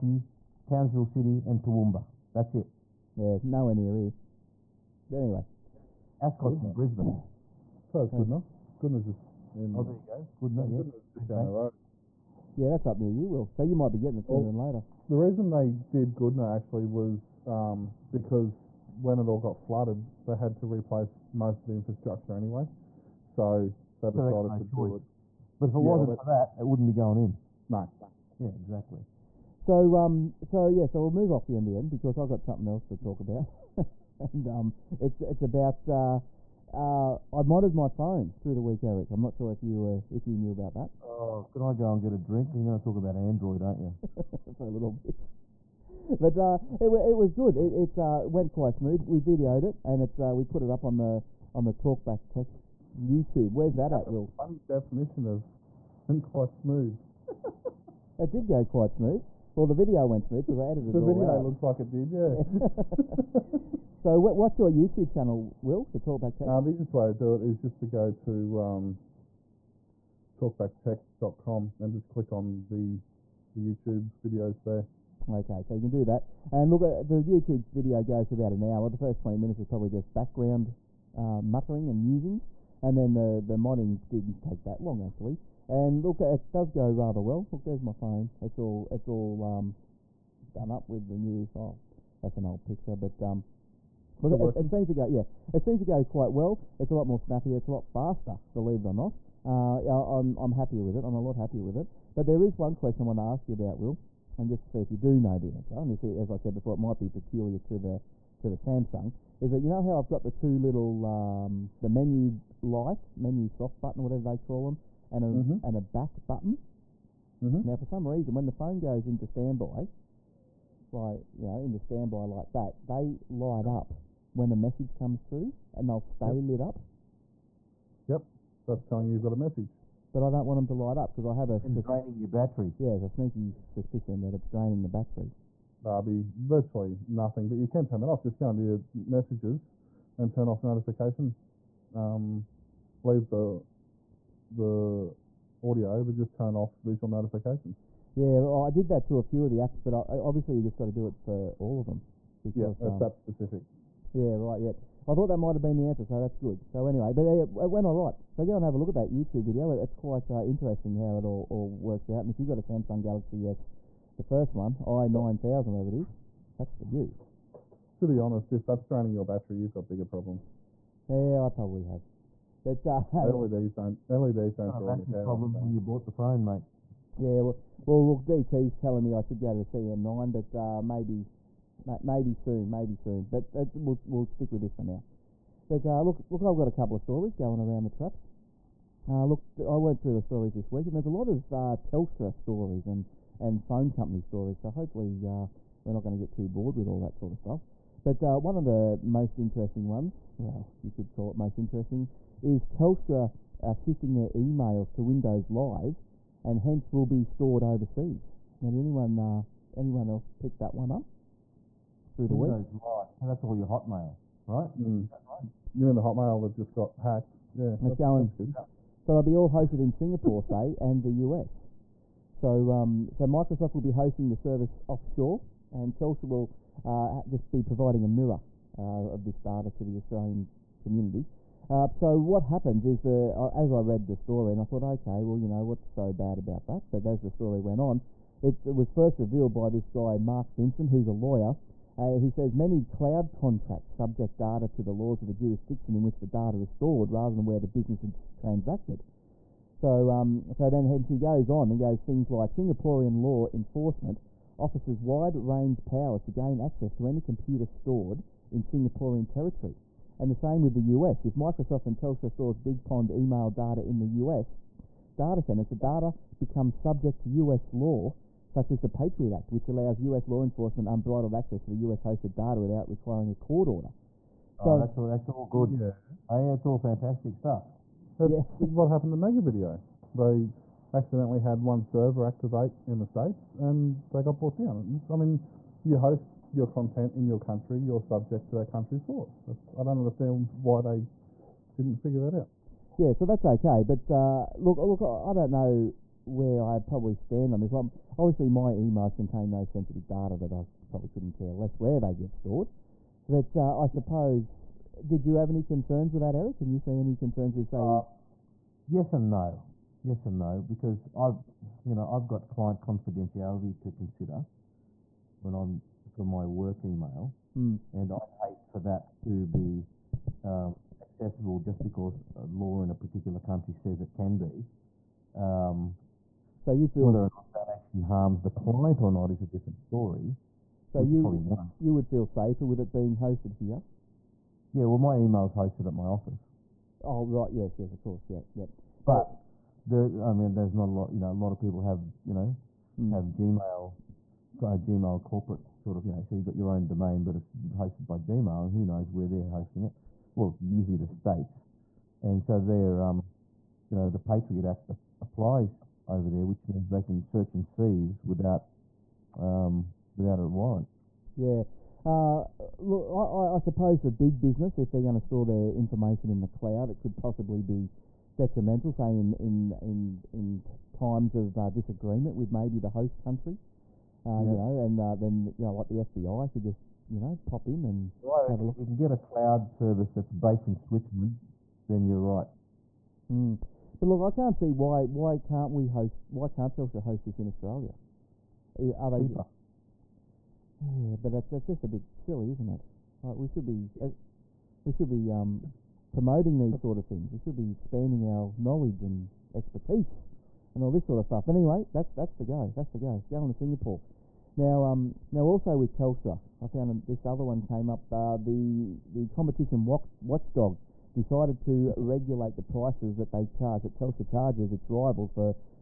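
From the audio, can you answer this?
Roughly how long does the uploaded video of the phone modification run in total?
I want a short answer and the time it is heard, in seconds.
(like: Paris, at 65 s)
about an hour, at 78 s.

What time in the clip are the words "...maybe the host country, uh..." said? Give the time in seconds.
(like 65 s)
372 s.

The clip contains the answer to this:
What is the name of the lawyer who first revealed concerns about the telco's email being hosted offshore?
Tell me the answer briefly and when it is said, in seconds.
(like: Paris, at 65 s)
Mark Vincent, at 240 s.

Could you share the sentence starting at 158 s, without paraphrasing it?
So go and have a look at that YouTube video.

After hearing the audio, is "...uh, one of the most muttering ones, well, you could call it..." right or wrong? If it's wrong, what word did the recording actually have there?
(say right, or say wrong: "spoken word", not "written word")
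wrong: "interesting", not "muttering".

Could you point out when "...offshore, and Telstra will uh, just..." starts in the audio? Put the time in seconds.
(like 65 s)
224 s.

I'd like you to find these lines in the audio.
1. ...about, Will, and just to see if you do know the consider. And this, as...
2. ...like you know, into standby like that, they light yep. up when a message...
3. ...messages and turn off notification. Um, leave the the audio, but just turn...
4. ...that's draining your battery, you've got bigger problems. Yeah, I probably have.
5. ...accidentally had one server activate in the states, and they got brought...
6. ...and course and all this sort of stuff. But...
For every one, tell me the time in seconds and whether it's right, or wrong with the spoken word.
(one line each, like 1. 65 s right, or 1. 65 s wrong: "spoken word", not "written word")
1. 103 s wrong: "answer", not "consider"
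2. 120 s right
3. 138 s right
4. 168 s right
5. 280 s right
6. 399 s wrong: "expertise", not "course".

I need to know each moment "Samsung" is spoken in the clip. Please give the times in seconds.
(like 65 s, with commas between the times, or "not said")
108 s, 162 s.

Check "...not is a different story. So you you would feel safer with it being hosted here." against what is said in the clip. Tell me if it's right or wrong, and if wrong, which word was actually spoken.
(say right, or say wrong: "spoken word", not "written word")
right.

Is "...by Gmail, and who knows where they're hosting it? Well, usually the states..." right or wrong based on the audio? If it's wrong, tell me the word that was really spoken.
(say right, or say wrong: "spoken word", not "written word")
right.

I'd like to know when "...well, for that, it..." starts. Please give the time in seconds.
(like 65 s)
26 s.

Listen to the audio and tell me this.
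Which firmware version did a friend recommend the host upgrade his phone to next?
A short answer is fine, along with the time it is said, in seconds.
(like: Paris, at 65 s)
CM9, at 179 s.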